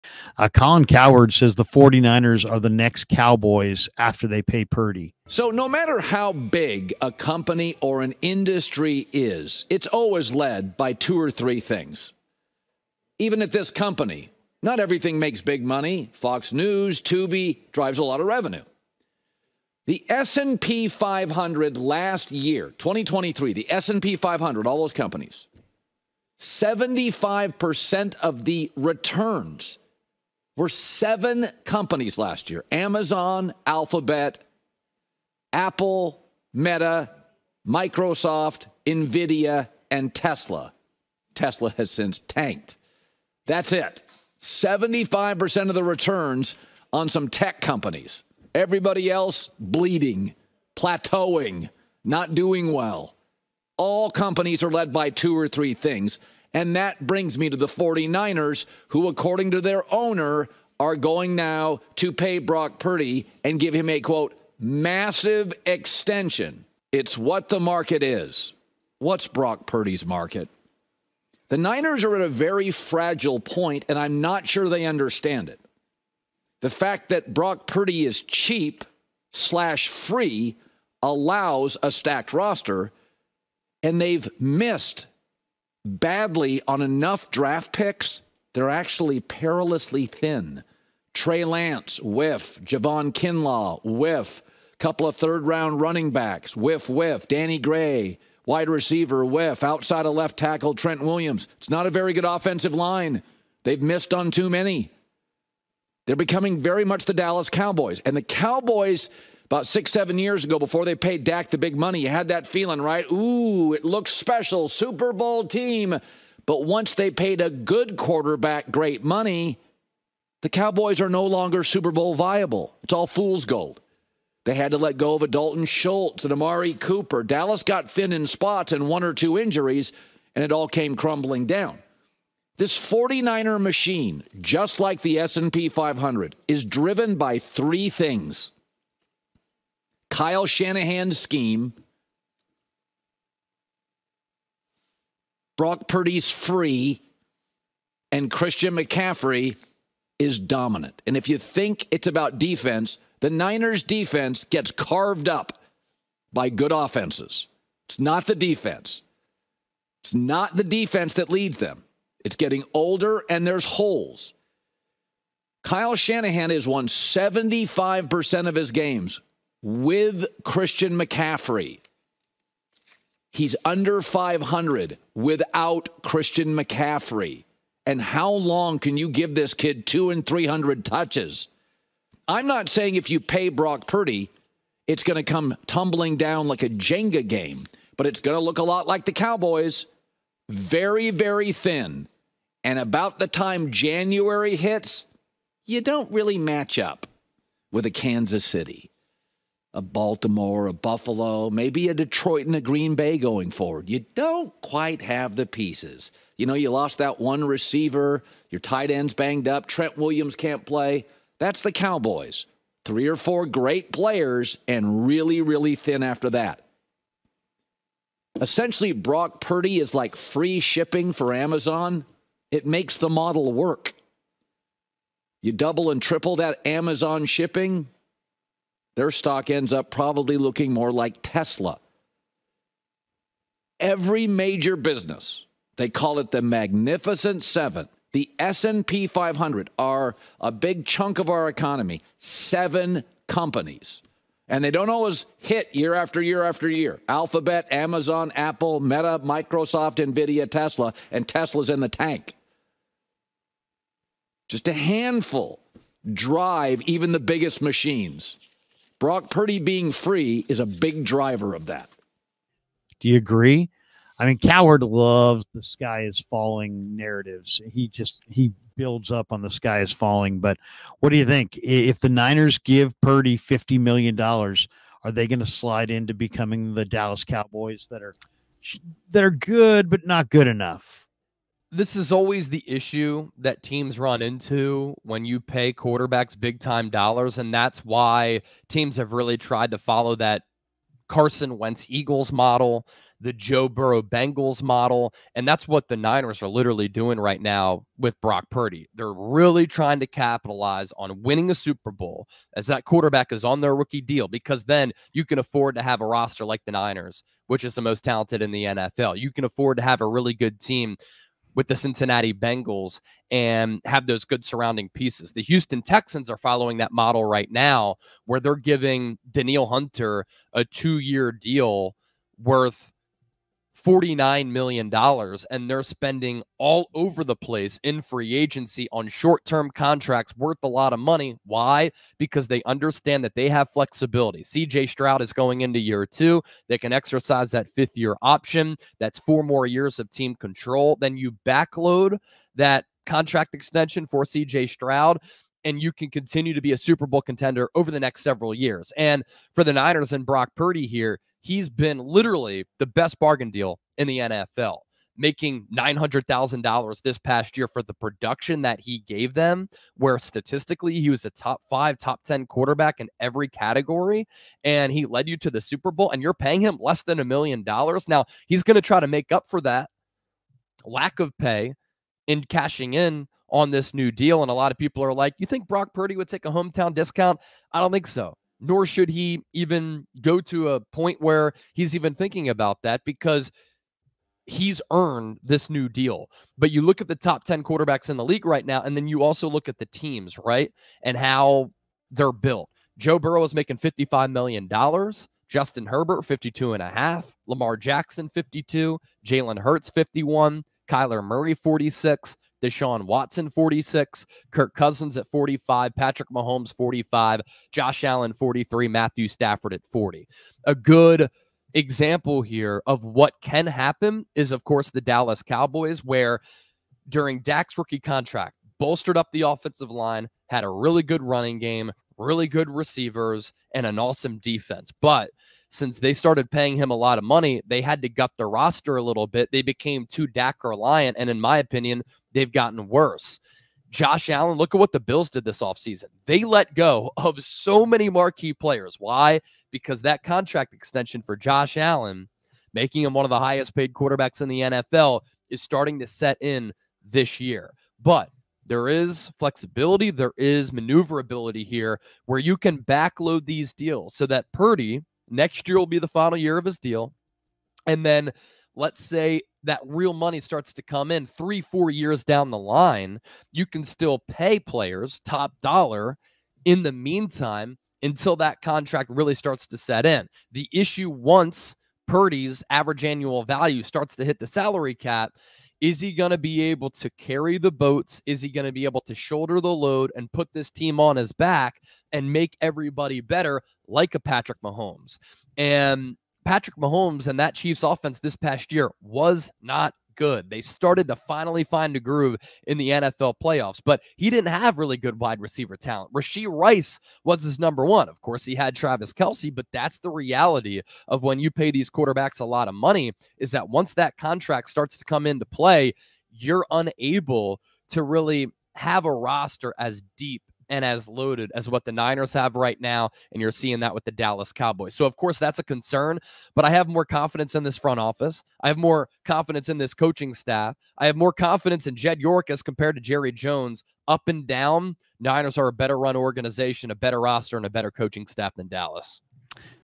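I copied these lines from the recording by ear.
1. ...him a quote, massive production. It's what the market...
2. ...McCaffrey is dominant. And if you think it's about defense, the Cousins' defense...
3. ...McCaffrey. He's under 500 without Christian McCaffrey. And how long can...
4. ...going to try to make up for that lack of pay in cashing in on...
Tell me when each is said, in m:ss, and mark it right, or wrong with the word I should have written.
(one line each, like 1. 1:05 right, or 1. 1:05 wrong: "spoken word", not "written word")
1. 1:03 wrong: "extension", not "production"
2. 2:28 wrong: "Niners", not "Cousins"
3. 2:50 right
4. 6:08 right.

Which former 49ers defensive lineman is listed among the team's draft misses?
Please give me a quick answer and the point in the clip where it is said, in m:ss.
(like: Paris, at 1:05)
Javon Kinlaw, at 1:32.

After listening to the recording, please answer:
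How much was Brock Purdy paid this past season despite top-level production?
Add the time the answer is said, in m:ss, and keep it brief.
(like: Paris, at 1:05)
$900,000, at 5:55.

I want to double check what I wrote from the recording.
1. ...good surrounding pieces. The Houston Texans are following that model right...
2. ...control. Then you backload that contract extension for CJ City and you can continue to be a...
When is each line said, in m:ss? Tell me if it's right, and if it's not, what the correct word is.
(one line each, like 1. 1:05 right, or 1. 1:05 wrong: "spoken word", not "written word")
1. 5:14 right
2. 5:40 wrong: "Stroud", not "City".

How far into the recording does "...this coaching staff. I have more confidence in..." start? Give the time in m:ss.
8:39.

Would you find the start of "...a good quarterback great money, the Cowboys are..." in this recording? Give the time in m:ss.
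1:57.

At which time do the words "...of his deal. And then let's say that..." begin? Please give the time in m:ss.
7:36.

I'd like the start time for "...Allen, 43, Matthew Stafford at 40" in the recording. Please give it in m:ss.
6:48.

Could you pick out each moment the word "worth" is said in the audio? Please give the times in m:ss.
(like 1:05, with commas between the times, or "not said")
5:22, 5:30.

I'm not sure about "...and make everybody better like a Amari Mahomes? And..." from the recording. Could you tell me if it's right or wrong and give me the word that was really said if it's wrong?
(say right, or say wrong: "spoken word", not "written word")
wrong: "Patrick", not "Amari".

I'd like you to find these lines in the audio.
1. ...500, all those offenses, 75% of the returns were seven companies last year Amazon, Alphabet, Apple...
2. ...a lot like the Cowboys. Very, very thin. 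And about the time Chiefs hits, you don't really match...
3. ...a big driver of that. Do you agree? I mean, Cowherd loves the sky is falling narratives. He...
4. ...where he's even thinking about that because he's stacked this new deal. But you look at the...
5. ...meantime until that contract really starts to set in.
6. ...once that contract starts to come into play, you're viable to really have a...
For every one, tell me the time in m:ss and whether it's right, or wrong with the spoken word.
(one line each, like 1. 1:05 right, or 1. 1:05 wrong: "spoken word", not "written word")
1. 0:24 wrong: "companies", not "offenses"
2. 3:08 wrong: "January", not "Chiefs"
3. 4:20 right
4. 6:21 wrong: "earned", not "stacked"
5. 7:46 right
6. 8:23 wrong: "unable", not "viable".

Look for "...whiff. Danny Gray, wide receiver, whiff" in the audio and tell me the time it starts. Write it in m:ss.
1:36.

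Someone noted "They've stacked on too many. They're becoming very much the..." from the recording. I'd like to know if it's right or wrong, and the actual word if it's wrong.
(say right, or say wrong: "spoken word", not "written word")
wrong: "missed", not "stacked".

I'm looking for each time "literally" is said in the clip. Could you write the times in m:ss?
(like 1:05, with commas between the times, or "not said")
4:56, 5:51.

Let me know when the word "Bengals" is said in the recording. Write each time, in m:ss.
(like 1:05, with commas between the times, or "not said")
4:54, 5:12.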